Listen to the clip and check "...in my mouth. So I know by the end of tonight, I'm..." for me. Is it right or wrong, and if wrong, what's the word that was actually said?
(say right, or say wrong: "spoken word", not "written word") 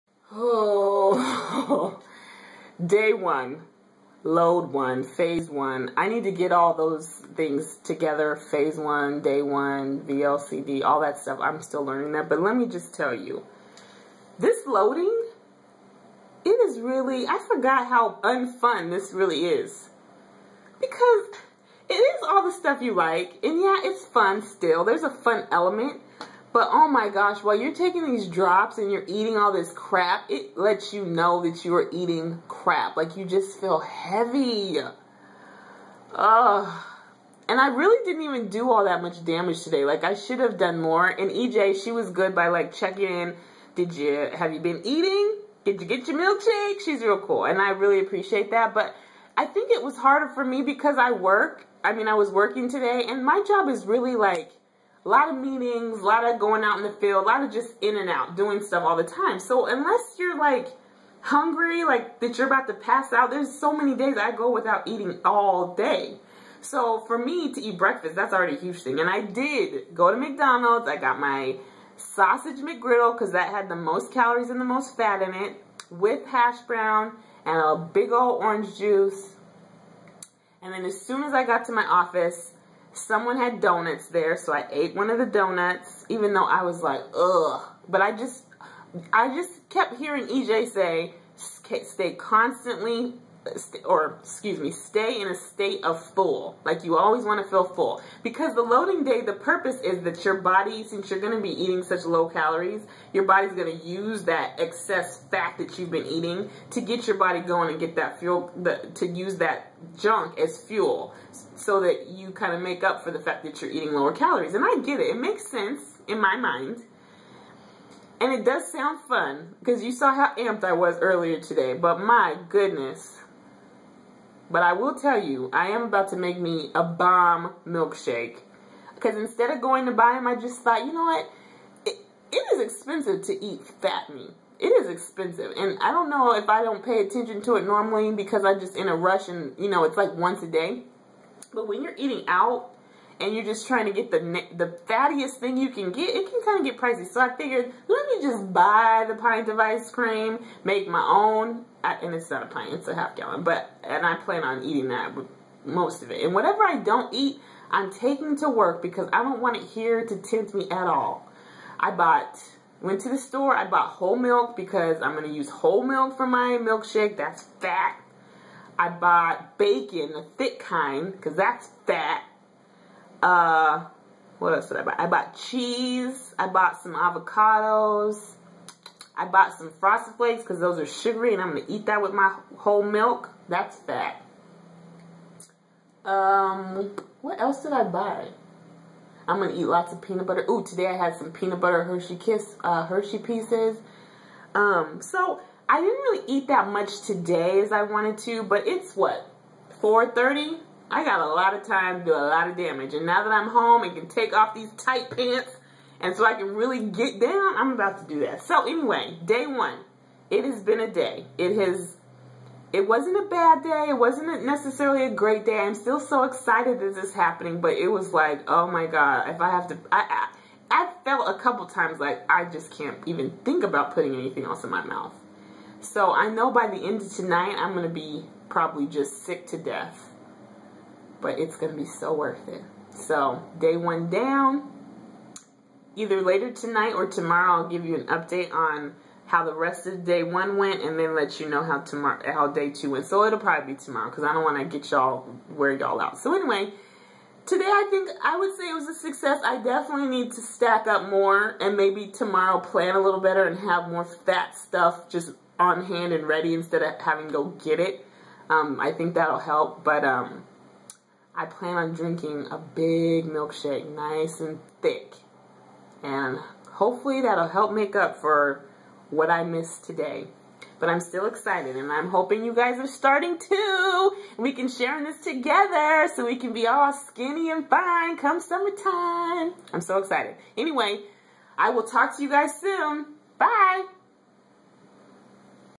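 right.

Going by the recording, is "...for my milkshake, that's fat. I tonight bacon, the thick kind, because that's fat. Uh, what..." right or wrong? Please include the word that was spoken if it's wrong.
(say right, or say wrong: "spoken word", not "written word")
wrong: "bought", not "tonight".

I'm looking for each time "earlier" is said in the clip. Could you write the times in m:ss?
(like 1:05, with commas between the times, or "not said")
2:00.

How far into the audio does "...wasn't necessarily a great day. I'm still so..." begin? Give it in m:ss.
3:33.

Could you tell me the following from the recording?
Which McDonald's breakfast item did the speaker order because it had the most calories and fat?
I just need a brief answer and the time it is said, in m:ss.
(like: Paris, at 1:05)
Sausage McGriddle, at 1:11.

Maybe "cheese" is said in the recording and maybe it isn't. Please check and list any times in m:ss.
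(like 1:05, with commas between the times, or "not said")
2:55.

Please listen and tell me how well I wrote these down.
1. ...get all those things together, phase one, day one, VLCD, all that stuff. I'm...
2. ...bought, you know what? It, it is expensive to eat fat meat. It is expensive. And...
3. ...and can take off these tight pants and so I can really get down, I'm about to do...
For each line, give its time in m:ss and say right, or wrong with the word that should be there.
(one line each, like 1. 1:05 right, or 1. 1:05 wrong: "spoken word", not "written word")
1. 0:06 right
2. 2:10 wrong: "thought", not "bought"
3. 3:23 right.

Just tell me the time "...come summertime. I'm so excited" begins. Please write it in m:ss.
4:38.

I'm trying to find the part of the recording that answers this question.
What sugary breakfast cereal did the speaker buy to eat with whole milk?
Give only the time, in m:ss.
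2:59.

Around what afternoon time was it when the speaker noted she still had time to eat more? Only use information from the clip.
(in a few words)
4:30.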